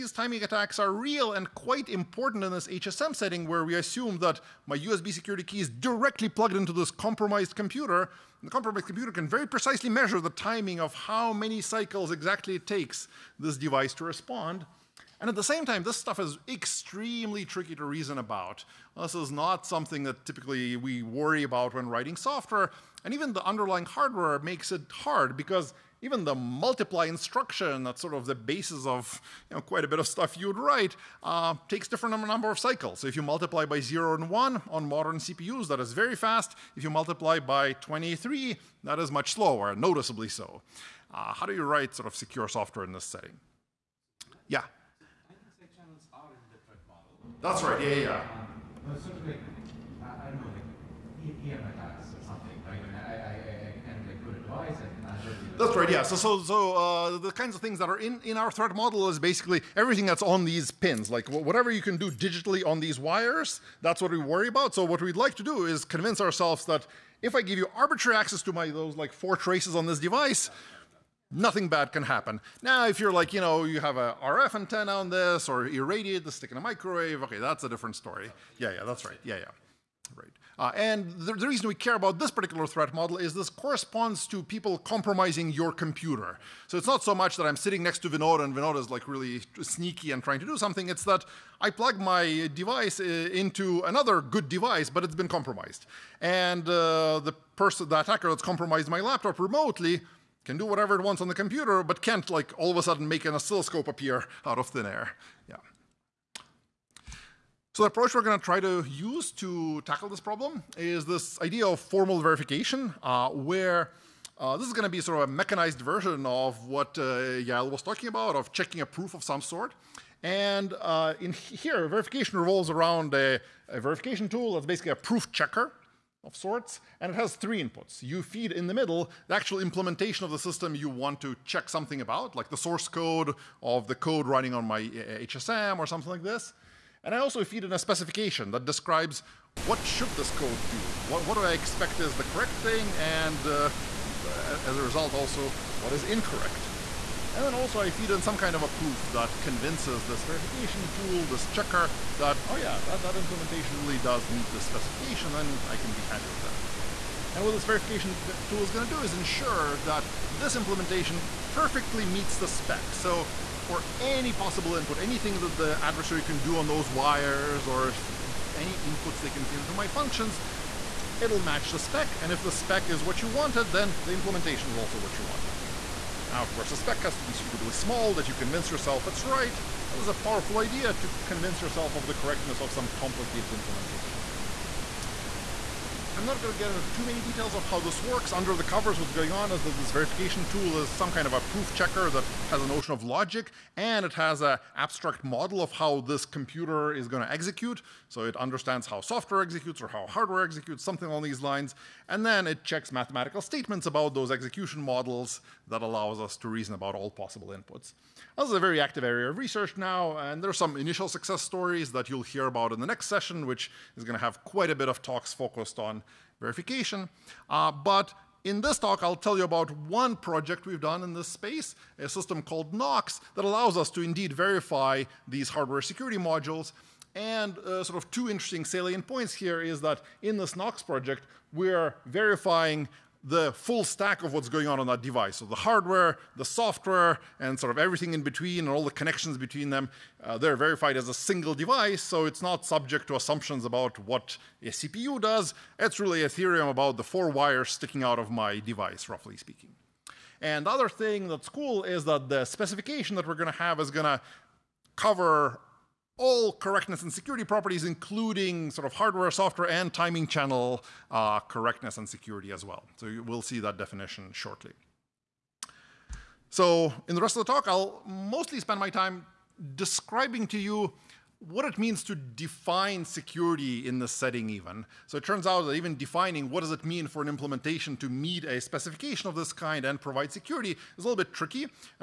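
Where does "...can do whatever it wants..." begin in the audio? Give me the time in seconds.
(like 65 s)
100 s.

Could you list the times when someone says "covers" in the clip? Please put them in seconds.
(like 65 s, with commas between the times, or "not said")
188 s, 254 s.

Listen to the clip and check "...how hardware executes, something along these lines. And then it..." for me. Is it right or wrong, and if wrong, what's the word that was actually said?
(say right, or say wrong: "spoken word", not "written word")
right.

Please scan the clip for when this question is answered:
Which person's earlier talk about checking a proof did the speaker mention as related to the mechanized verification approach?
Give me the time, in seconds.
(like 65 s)
117 s.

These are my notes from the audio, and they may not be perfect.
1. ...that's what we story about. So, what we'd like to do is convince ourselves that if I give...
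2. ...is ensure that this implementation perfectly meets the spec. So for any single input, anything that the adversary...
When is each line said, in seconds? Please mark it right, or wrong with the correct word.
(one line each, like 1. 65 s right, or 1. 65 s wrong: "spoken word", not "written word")
1. 63 s wrong: "worry", not "story"
2. 159 s wrong: "possible", not "single".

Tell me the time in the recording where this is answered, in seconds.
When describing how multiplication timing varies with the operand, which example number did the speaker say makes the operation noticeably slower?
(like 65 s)
37 s.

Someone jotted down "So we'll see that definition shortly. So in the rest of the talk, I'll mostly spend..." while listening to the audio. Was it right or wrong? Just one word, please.
right.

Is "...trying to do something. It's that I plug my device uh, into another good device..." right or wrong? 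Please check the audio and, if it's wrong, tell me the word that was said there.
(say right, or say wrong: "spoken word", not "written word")
right.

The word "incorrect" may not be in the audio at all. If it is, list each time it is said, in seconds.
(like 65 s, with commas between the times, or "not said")
146 s.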